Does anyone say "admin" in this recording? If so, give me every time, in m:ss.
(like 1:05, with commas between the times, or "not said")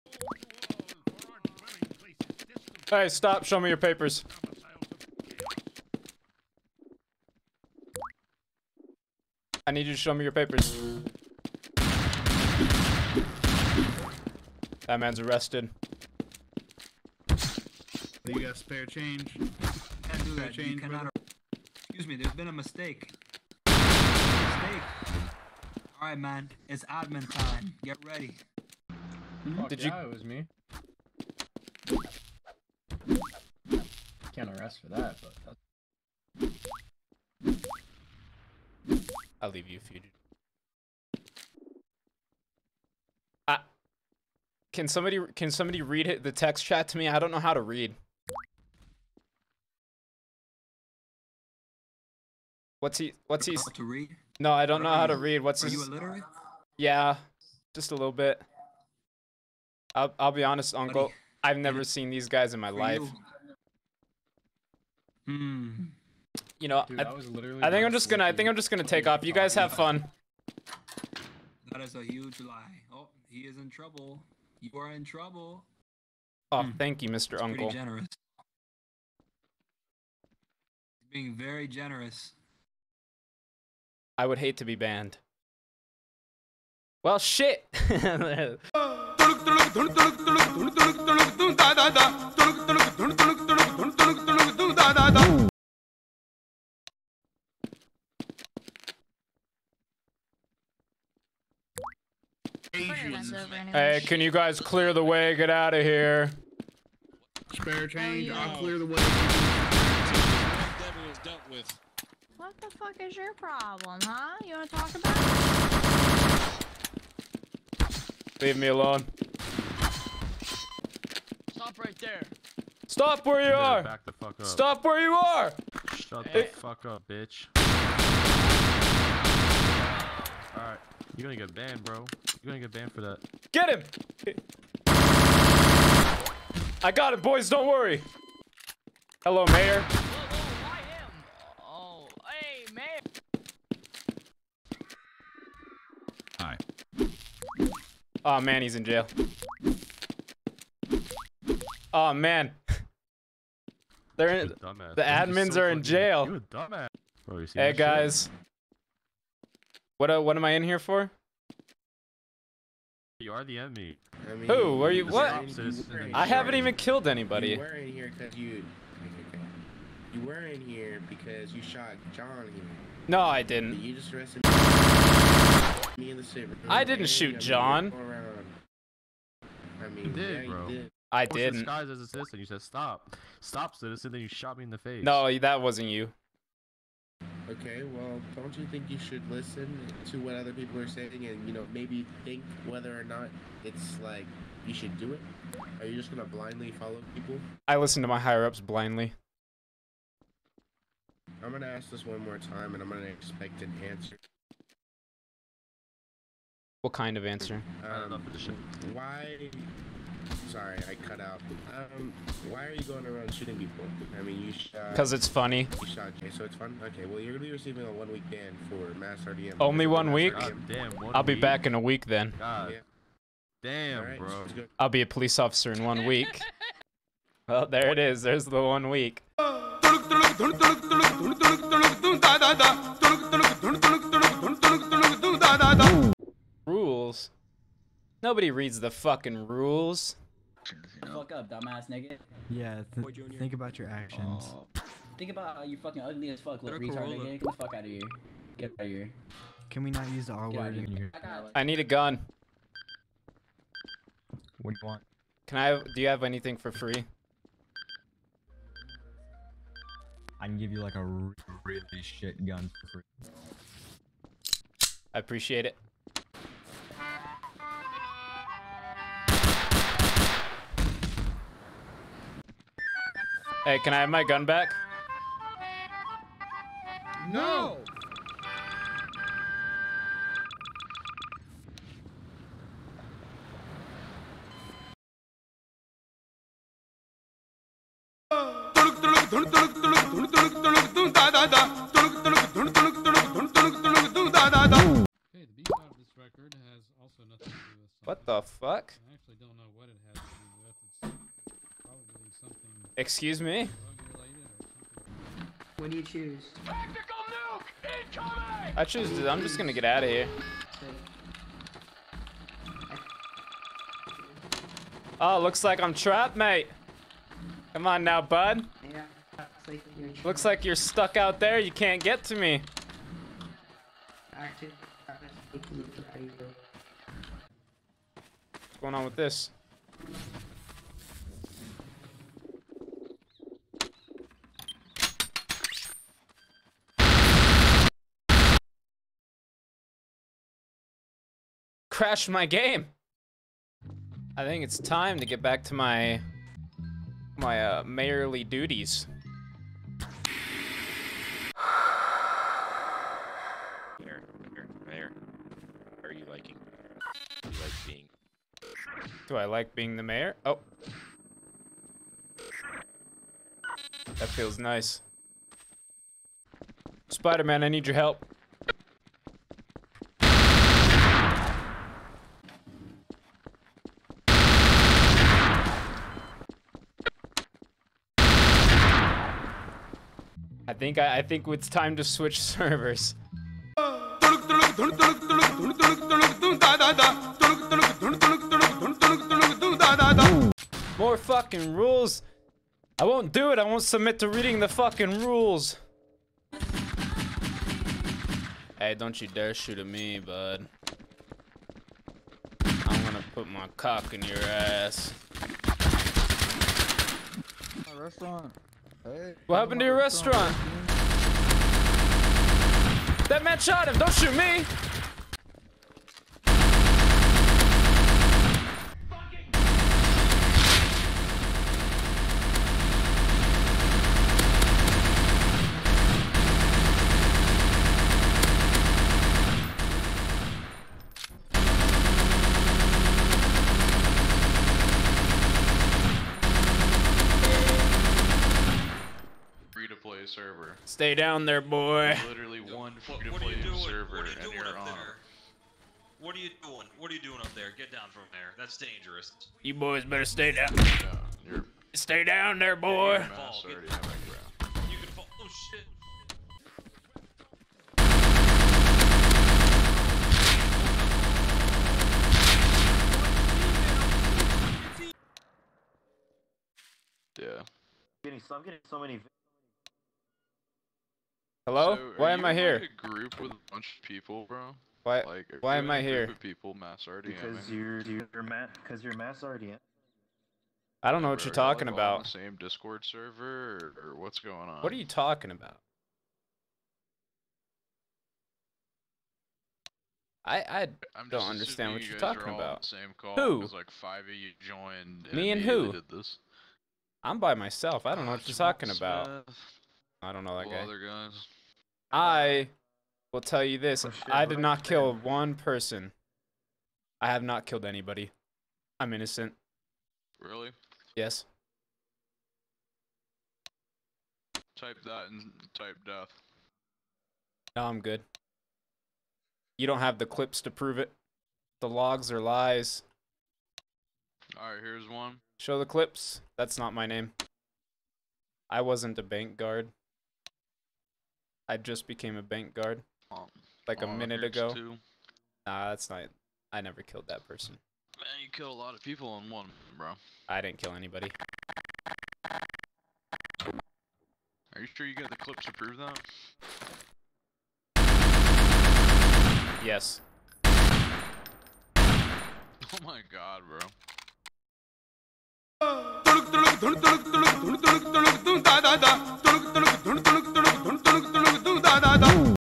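0:26, 2:35.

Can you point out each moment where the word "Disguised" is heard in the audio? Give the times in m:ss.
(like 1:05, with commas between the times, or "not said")
3:01.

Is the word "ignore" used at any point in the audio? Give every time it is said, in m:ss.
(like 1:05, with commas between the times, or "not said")
not said.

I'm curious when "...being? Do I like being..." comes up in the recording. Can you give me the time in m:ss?
5:57.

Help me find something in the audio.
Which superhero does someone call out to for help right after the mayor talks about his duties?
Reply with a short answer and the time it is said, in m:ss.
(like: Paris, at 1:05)
Spider-Man, at 6:07.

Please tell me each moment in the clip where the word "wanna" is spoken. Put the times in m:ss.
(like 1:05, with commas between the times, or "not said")
1:54.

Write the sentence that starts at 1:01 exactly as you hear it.
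I've never seen these guys in my life.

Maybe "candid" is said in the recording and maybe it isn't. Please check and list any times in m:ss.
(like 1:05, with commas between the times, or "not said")
not said.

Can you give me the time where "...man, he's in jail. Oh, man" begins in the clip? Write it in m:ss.
2:28.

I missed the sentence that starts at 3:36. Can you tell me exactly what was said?
Okay, well, you're going to be receiving a one-week ban for mass RDM.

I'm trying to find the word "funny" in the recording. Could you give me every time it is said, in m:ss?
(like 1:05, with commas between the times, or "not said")
3:35.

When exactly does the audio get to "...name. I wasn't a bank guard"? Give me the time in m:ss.
8:47.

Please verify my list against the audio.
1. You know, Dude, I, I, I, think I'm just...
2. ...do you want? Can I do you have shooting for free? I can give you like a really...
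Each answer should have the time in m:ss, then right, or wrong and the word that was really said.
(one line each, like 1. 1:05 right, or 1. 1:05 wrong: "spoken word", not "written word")
1. 1:06 right
2. 4:14 wrong: "anything", not "shooting".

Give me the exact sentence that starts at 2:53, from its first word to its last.
You just arrested me in the I didn't shoot John.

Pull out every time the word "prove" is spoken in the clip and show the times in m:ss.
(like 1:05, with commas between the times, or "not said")
8:40, 9:05.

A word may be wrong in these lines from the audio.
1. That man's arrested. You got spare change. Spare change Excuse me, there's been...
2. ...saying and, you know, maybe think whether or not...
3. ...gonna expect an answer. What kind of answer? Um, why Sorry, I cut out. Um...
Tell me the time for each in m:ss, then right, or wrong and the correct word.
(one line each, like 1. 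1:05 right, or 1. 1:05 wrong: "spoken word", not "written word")
1. 0:14 right
2. 3:10 right
3. 3:22 right.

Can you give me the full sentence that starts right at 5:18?
Yeah, looks like you're, looks like you're stuck out there.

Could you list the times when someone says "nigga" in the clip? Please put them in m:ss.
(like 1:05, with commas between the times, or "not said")
4:01, 4:07.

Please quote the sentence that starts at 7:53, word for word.
a group with a bunch of people, bro.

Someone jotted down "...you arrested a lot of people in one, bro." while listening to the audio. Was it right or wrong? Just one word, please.
wrong.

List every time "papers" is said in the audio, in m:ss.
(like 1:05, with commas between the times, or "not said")
0:03, 0:10.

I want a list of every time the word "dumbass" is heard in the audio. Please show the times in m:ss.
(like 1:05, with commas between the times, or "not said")
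2:37, 4:01.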